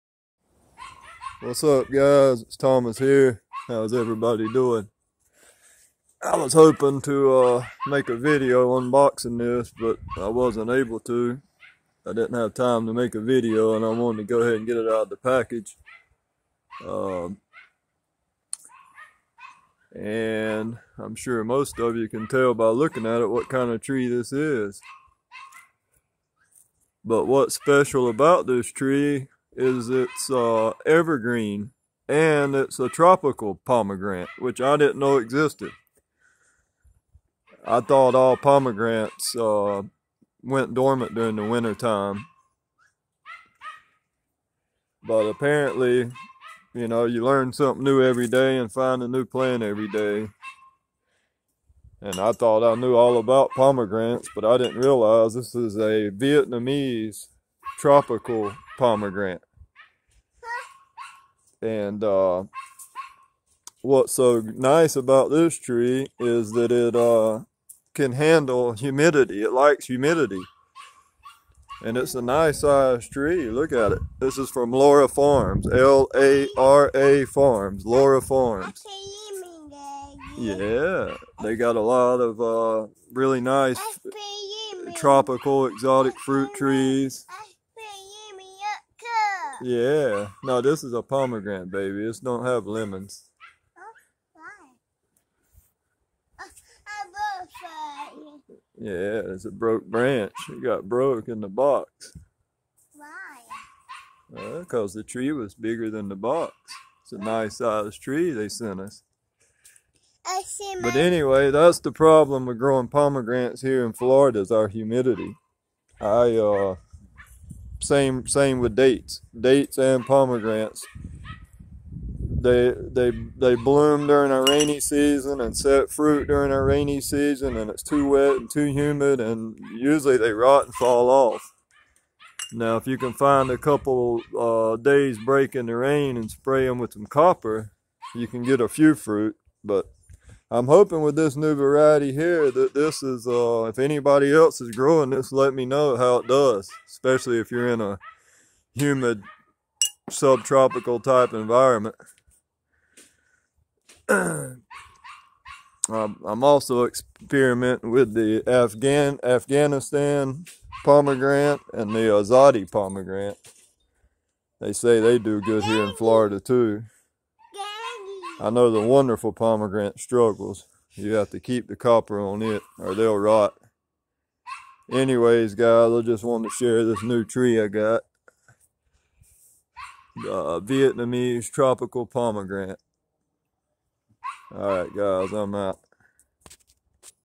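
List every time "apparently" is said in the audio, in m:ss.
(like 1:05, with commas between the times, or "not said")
0:45.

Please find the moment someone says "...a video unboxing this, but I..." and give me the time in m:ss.
0:08.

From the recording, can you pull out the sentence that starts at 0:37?
I thought all pomegranates uh, went dormant during the winter time.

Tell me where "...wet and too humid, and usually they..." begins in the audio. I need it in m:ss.
2:08.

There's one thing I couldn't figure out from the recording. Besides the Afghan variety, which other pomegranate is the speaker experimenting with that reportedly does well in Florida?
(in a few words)
Azadi.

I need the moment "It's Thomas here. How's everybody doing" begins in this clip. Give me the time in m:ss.
0:02.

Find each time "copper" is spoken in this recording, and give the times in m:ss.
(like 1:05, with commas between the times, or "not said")
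2:17, 2:51.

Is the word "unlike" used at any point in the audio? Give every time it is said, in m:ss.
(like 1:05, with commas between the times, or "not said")
not said.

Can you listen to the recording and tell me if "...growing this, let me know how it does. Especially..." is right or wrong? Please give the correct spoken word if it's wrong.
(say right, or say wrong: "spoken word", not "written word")
right.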